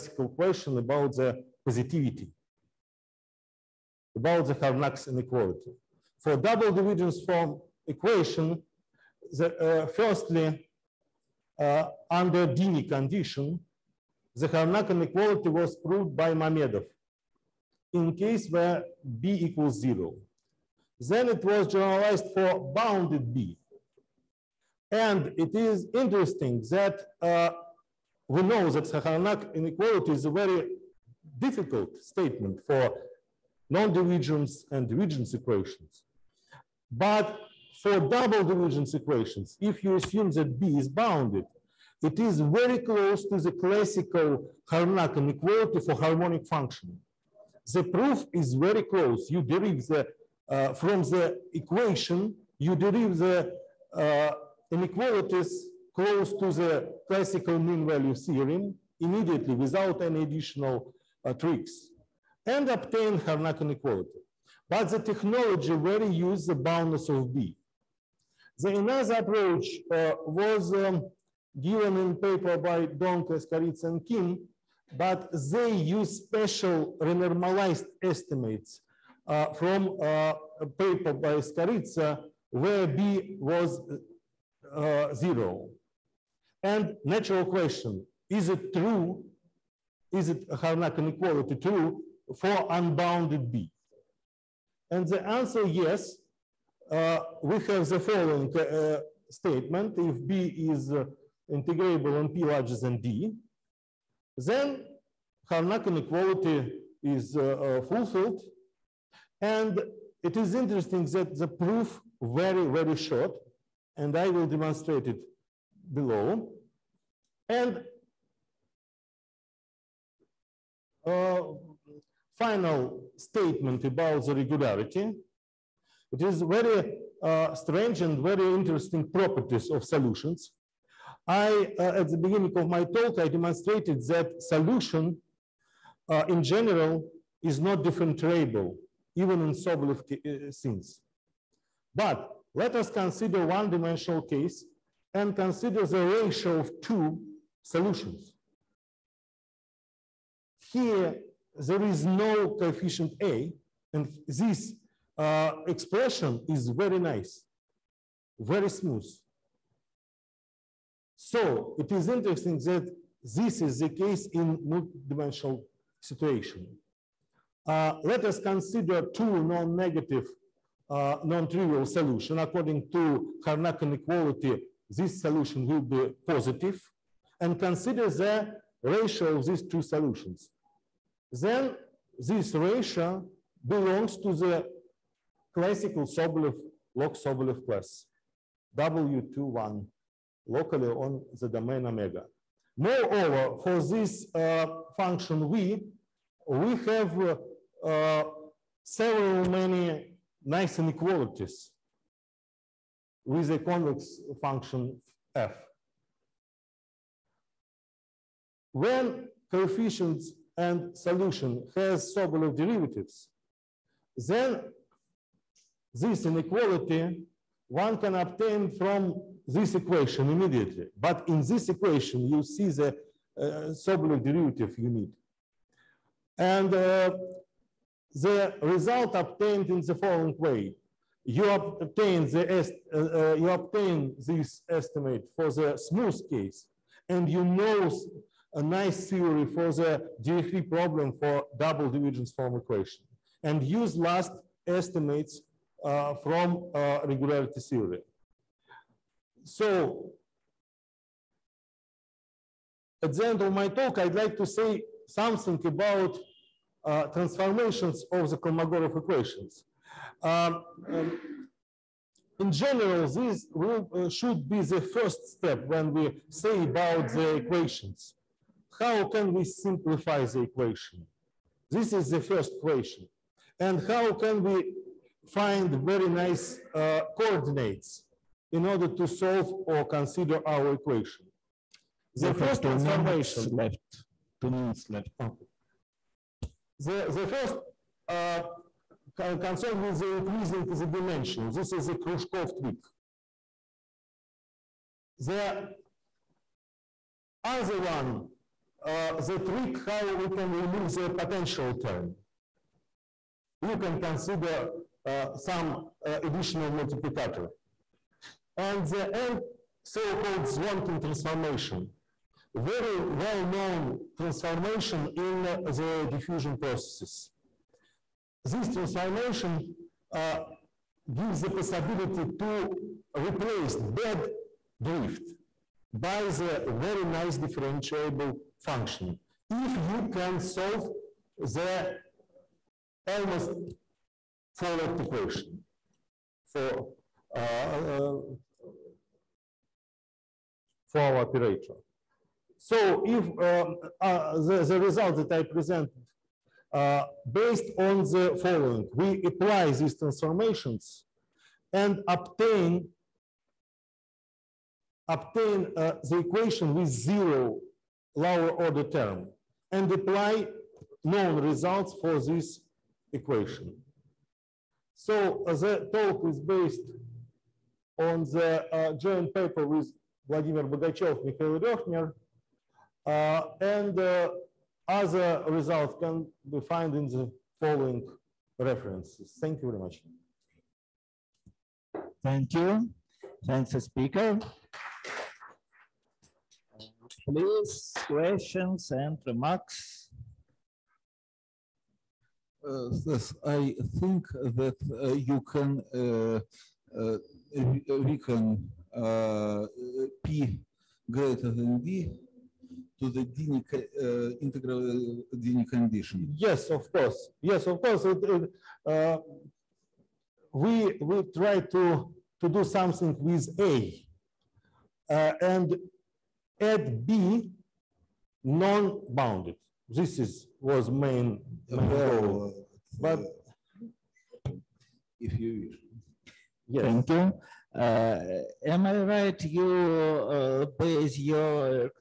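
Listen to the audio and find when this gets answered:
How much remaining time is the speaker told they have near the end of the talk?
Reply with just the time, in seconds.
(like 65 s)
284 s.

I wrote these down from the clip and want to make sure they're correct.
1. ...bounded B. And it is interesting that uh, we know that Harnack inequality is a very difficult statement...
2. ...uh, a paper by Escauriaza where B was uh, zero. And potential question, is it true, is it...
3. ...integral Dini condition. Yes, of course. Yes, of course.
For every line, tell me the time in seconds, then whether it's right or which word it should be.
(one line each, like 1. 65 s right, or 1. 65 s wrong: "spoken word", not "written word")
1. 22 s right
2. 80 s wrong: "natural", not "potential"
3. 404 s right.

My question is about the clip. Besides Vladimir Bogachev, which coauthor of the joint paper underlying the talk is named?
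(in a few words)
Mikhail Röckner.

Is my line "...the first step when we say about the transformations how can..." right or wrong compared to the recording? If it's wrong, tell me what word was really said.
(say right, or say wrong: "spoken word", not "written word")
wrong: "equations", not "transformations".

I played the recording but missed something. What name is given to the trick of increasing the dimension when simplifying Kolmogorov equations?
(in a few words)
Khrushchev trick.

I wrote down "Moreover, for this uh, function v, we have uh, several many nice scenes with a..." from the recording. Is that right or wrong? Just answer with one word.
wrong.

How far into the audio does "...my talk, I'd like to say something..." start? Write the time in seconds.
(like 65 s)
253 s.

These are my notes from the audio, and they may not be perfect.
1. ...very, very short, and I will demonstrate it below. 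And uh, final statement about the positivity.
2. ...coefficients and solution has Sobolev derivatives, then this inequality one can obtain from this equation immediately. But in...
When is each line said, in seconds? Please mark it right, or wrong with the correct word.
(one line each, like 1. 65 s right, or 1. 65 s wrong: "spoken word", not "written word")
1. 112 s wrong: "regularity", not "positivity"
2. 209 s right.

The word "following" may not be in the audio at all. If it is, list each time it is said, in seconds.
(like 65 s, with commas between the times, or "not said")
97 s, 229 s, 348 s, 377 s.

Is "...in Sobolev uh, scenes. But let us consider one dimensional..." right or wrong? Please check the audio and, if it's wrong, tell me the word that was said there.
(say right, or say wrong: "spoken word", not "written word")
right.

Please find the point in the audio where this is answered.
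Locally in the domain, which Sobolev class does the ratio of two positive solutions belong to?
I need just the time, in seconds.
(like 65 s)
188 s.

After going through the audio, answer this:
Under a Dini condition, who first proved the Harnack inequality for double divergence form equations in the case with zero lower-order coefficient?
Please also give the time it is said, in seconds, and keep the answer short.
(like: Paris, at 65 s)
Mamedov, at 16 s.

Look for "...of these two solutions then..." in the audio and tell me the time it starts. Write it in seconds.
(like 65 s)
179 s.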